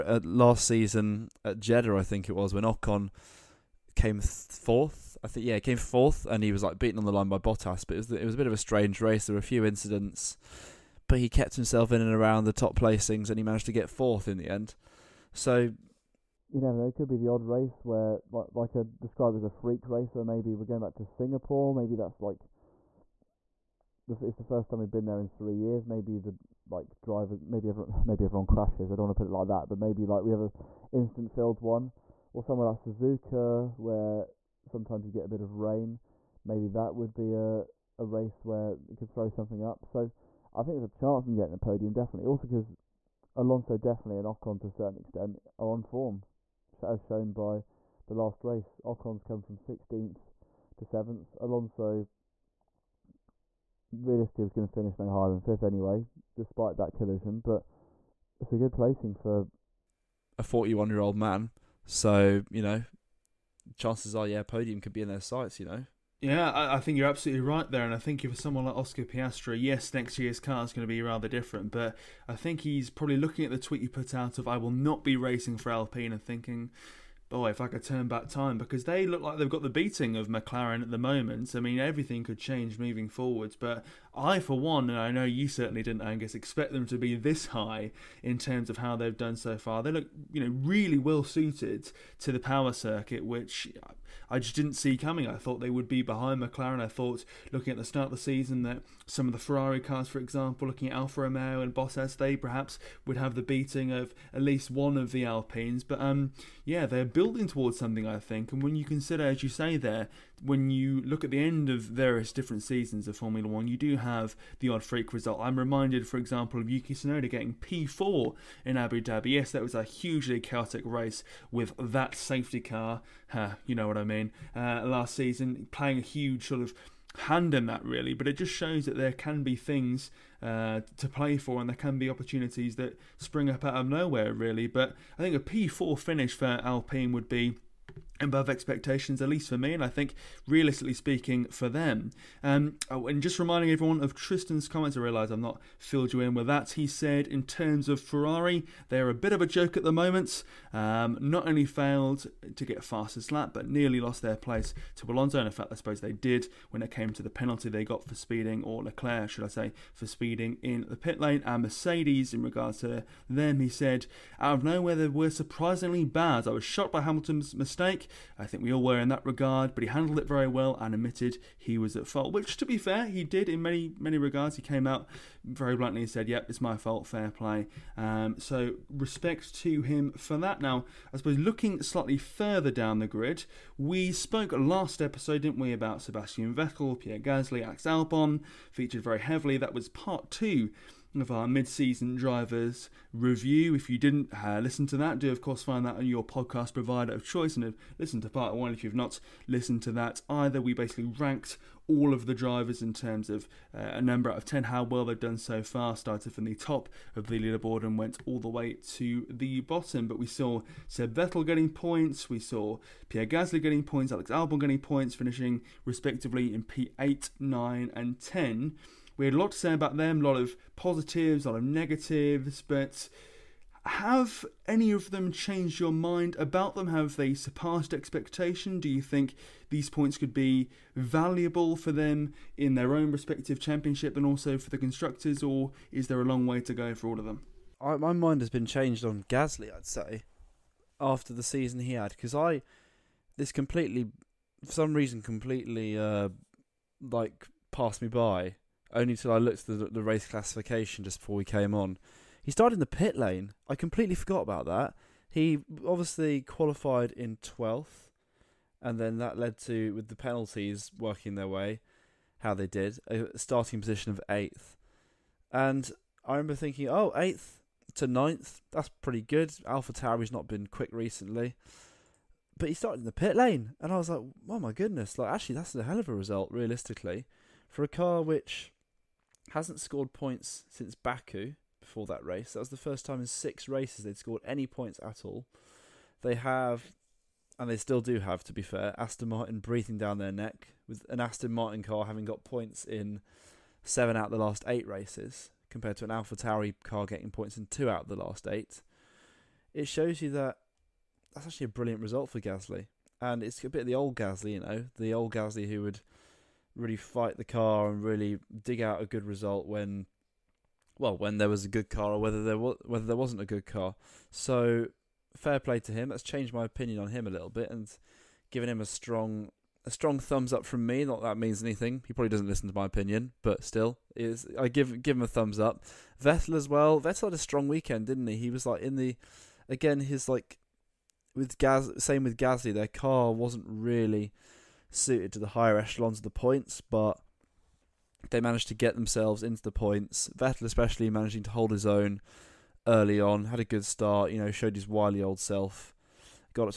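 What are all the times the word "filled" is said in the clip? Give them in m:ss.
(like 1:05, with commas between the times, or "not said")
0:31, 2:25.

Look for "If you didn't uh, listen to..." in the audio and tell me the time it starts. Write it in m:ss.
3:13.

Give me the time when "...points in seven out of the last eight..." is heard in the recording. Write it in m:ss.
4:52.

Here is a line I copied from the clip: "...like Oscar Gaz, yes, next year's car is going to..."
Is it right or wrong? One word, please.
wrong.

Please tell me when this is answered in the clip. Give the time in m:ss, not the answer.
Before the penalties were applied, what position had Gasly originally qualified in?
4:17.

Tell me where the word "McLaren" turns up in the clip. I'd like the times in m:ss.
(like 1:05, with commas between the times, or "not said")
1:20, 1:36.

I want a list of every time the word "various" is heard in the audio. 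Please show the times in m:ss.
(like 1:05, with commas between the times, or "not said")
1:51.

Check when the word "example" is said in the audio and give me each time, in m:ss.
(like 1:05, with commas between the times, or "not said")
1:40, 1:56.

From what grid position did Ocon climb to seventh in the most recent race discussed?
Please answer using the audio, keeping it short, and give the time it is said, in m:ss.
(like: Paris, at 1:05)
16th, at 0:49.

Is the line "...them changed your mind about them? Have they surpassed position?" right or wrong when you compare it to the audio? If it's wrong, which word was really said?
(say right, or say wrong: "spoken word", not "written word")
wrong: "expectation", not "position".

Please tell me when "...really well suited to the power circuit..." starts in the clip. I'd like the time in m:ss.
1:30.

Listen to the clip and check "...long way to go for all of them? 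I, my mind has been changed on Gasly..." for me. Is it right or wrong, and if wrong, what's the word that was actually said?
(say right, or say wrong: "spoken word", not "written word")
right.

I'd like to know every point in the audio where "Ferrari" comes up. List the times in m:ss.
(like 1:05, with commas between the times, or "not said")
1:39, 2:28.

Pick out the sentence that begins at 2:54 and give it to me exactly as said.
He came out very bluntly and said, Yep, it's my fault, fair play.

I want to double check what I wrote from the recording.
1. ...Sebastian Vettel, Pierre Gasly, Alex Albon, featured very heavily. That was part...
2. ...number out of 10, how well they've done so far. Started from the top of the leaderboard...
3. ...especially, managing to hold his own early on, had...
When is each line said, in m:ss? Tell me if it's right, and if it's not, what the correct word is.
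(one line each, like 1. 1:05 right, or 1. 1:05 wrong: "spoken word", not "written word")
1. 3:06 right
2. 3:24 right
3. 5:40 right.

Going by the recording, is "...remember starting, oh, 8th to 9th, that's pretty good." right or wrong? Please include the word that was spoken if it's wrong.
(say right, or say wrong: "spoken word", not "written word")
wrong: "thinking", not "starting".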